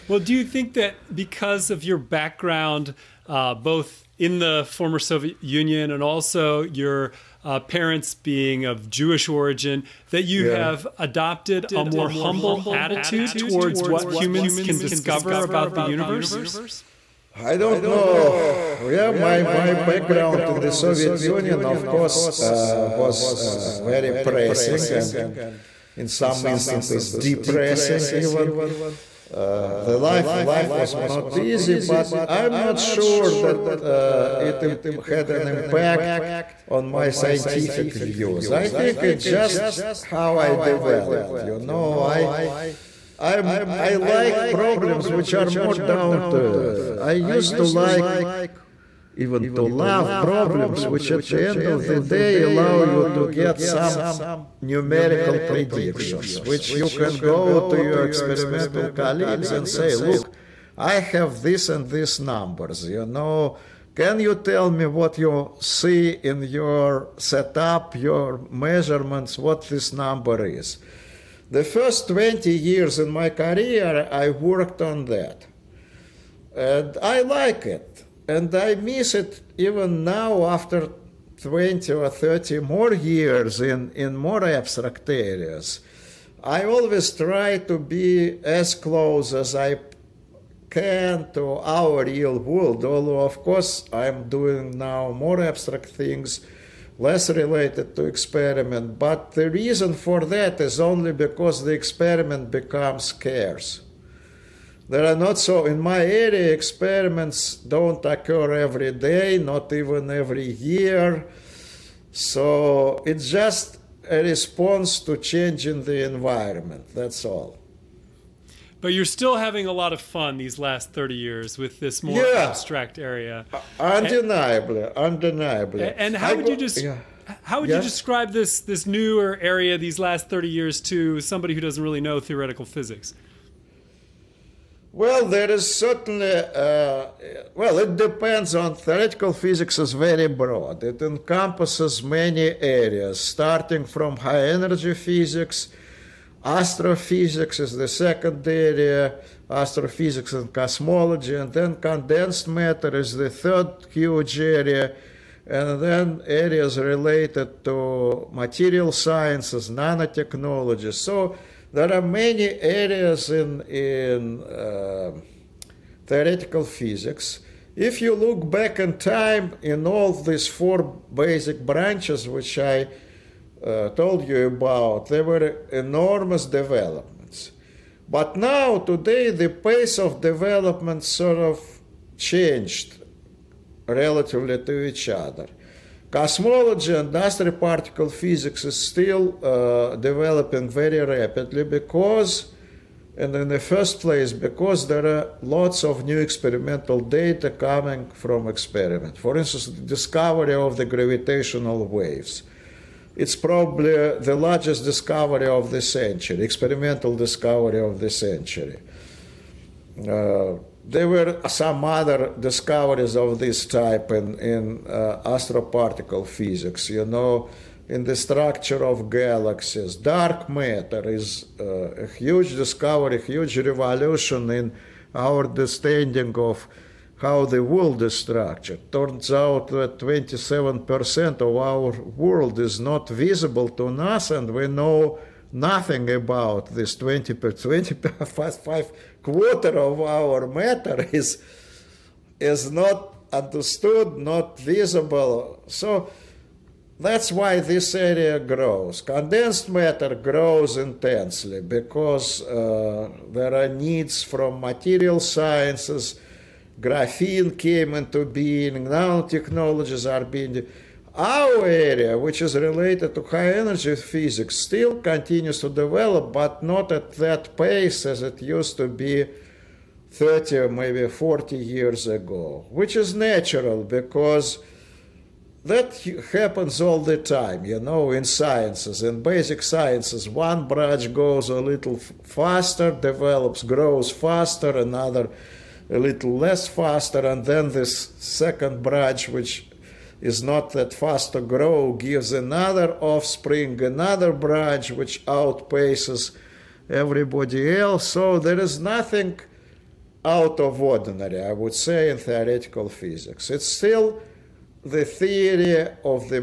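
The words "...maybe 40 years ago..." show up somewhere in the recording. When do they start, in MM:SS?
04:30.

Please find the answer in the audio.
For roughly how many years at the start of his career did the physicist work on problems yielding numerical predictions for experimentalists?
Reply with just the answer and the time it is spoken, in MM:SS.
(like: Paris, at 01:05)
20, at 01:11.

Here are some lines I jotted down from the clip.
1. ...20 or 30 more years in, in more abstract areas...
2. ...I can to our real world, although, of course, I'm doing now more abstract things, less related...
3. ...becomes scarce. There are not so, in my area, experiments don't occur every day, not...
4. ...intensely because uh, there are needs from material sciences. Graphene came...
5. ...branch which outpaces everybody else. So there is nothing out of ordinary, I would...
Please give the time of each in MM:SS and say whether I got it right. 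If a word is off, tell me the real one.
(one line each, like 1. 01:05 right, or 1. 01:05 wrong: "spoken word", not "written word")
1. 01:21 right
2. 01:29 right
3. 01:42 right
4. 04:10 right
5. 04:54 right.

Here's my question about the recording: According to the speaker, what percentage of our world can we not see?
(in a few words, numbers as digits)
27%.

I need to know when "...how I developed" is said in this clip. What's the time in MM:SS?
00:39.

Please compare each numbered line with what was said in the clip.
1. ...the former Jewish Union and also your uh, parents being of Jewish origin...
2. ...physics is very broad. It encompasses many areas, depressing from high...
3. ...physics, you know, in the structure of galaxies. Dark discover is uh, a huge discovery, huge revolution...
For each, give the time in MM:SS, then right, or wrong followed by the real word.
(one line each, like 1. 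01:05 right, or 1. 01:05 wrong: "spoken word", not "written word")
1. 00:04 wrong: "Soviet", not "Jewish"
2. 02:19 wrong: "starting", not "depressing"
3. 03:36 wrong: "matter", not "discover".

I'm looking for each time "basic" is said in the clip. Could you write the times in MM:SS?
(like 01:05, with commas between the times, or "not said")
02:51, 04:39.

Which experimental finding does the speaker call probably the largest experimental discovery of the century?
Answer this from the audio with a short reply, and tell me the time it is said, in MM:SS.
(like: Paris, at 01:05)
gravitational waves, at 03:20.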